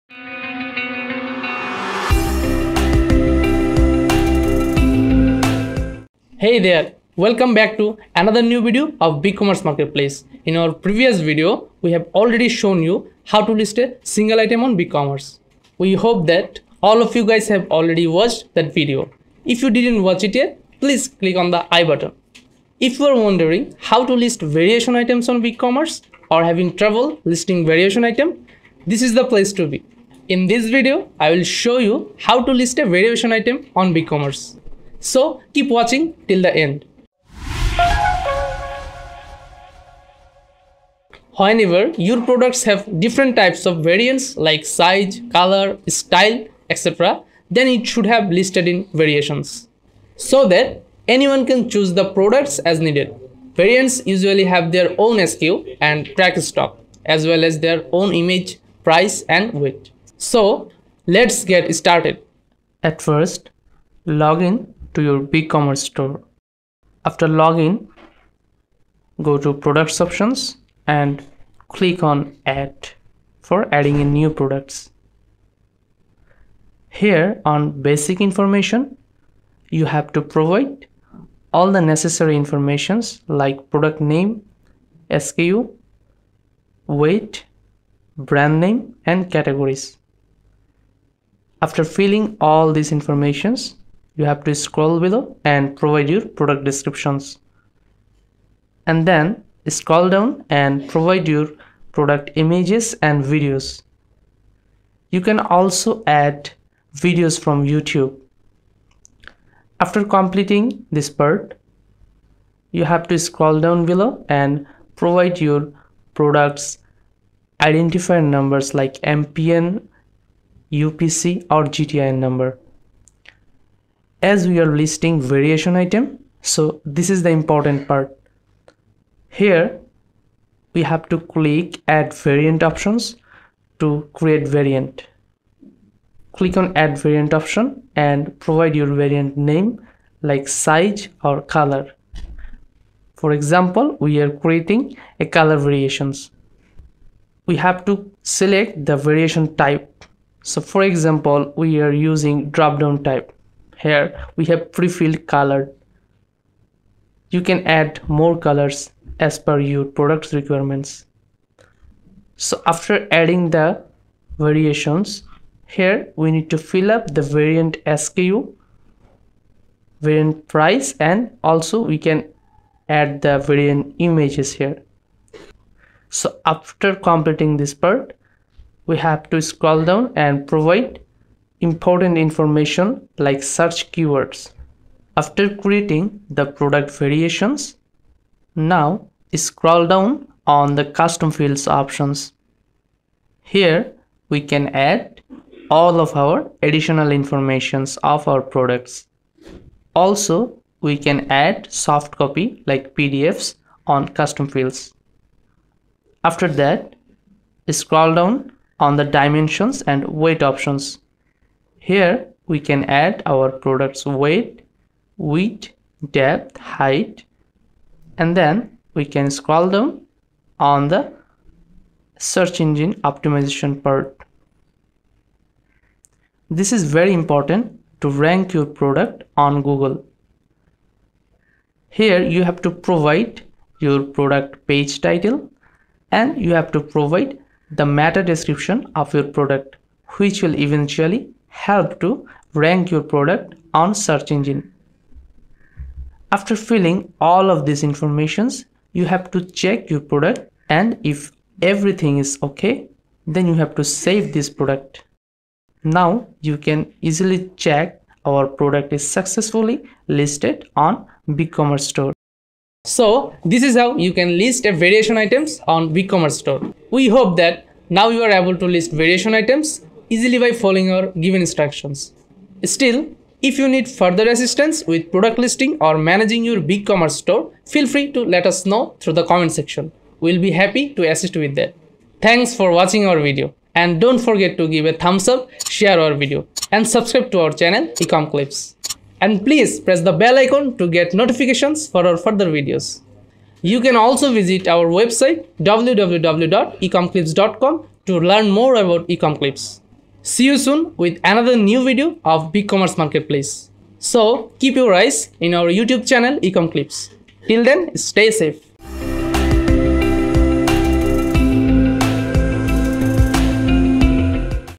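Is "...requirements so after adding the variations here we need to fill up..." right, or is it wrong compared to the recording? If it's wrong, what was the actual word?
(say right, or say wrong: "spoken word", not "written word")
right.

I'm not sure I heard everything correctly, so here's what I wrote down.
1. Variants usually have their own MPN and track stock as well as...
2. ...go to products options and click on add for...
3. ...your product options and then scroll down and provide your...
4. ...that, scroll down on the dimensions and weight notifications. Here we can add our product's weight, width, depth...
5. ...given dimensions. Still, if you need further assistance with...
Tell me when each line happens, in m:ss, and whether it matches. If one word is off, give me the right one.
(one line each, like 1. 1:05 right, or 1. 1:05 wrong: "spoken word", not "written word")
1. 0:53 wrong: "SKU", not "MPN"
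2. 1:09 right
3. 1:36 wrong: "descriptions", not "options"
4. 3:26 wrong: "options", not "notifications"
5. 4:31 wrong: "instructions", not "dimensions".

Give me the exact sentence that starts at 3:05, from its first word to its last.
After creating the product variations, now scroll down on the custom fields options.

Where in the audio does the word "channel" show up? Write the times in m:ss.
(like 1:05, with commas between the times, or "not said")
4:47, 5:06.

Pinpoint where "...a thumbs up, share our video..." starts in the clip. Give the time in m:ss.
4:44.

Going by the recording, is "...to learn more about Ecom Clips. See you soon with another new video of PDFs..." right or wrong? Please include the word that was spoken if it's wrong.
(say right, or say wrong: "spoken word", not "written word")
wrong: "BigCommerce", not "PDFs".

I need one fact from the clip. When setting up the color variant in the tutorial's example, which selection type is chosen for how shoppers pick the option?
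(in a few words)
Drop down.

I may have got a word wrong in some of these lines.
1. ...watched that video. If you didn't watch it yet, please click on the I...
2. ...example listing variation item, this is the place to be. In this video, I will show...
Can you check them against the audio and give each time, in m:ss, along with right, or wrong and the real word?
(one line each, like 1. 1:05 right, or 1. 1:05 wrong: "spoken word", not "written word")
1. 0:18 right
2. 0:26 wrong: "trouble", not "example".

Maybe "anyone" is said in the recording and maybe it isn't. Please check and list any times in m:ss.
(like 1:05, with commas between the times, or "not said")
0:51.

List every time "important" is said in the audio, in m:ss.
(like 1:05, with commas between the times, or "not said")
2:07, 3:01, 3:47.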